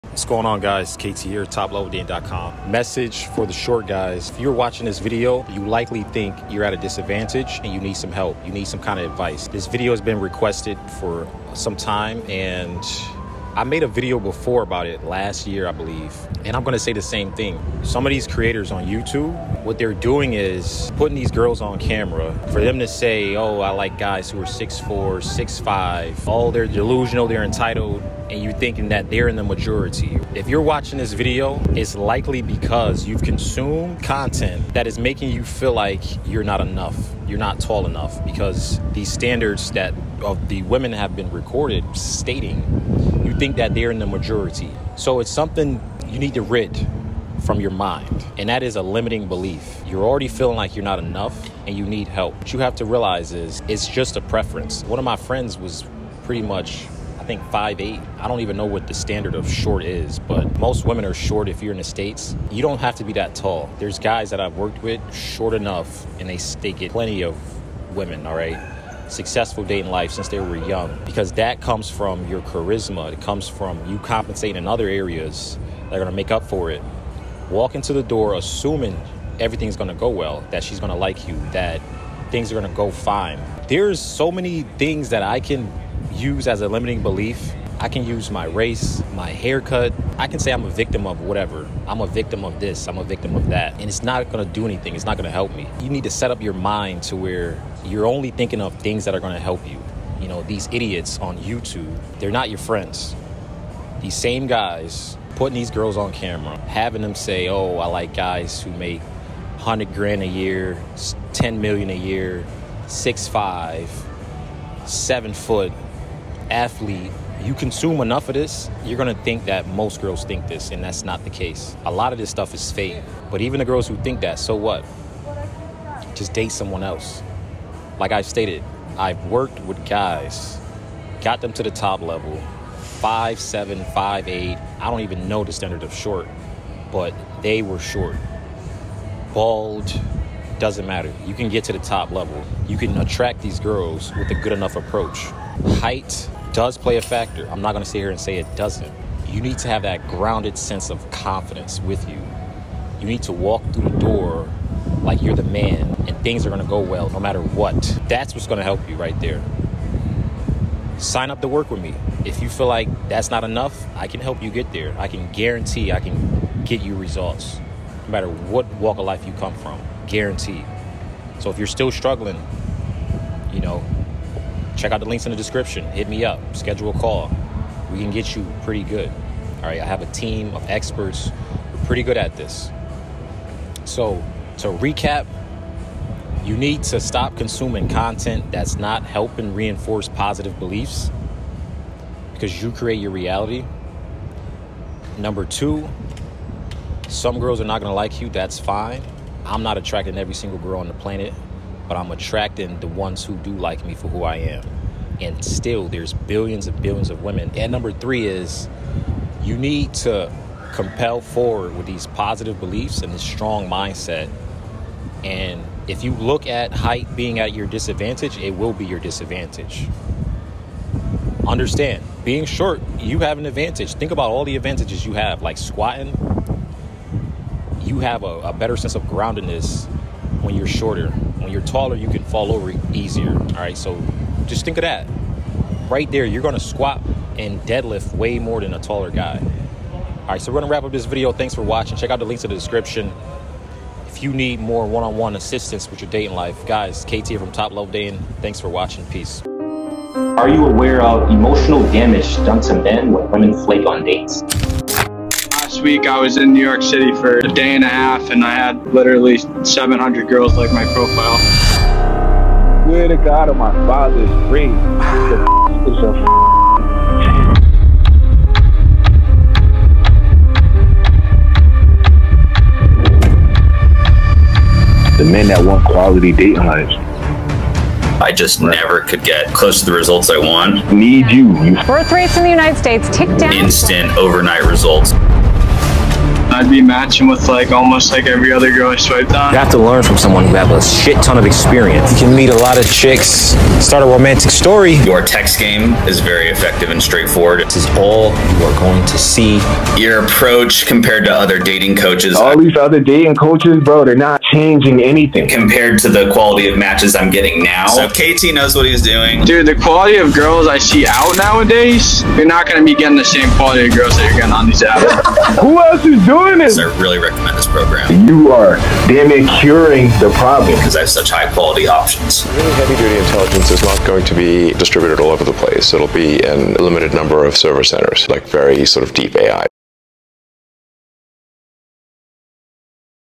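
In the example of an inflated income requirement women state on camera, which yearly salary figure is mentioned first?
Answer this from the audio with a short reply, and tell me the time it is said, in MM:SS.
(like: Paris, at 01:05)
100 grand, at 01:49.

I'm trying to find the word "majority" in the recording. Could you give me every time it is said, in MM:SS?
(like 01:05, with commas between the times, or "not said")
00:29, 00:44.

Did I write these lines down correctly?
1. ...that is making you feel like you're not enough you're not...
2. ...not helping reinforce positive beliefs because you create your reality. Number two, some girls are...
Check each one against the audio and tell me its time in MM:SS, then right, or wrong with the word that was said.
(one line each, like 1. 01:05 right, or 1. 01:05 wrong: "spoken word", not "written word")
1. 00:34 right
2. 03:08 right.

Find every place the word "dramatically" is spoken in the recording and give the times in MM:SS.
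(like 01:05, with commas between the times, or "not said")
not said.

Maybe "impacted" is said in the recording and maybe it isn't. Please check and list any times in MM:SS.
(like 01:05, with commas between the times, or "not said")
not said.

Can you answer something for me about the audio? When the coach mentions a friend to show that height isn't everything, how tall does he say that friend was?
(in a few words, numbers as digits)
5'8.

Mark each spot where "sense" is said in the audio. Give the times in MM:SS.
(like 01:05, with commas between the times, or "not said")
02:30, 03:48.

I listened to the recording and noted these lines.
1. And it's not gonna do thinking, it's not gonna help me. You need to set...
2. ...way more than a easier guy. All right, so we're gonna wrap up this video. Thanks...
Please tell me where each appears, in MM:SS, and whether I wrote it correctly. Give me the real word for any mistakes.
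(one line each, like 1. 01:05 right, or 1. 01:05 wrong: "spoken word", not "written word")
1. 01:33 wrong: "anything", not "thinking"
2. 03:58 wrong: "taller", not "easier".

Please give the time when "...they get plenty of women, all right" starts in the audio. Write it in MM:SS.
01:06.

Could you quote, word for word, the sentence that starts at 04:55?
Your text game is very effective and straightforward.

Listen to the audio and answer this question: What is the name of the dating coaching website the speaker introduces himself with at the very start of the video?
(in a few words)
topleveldating.com.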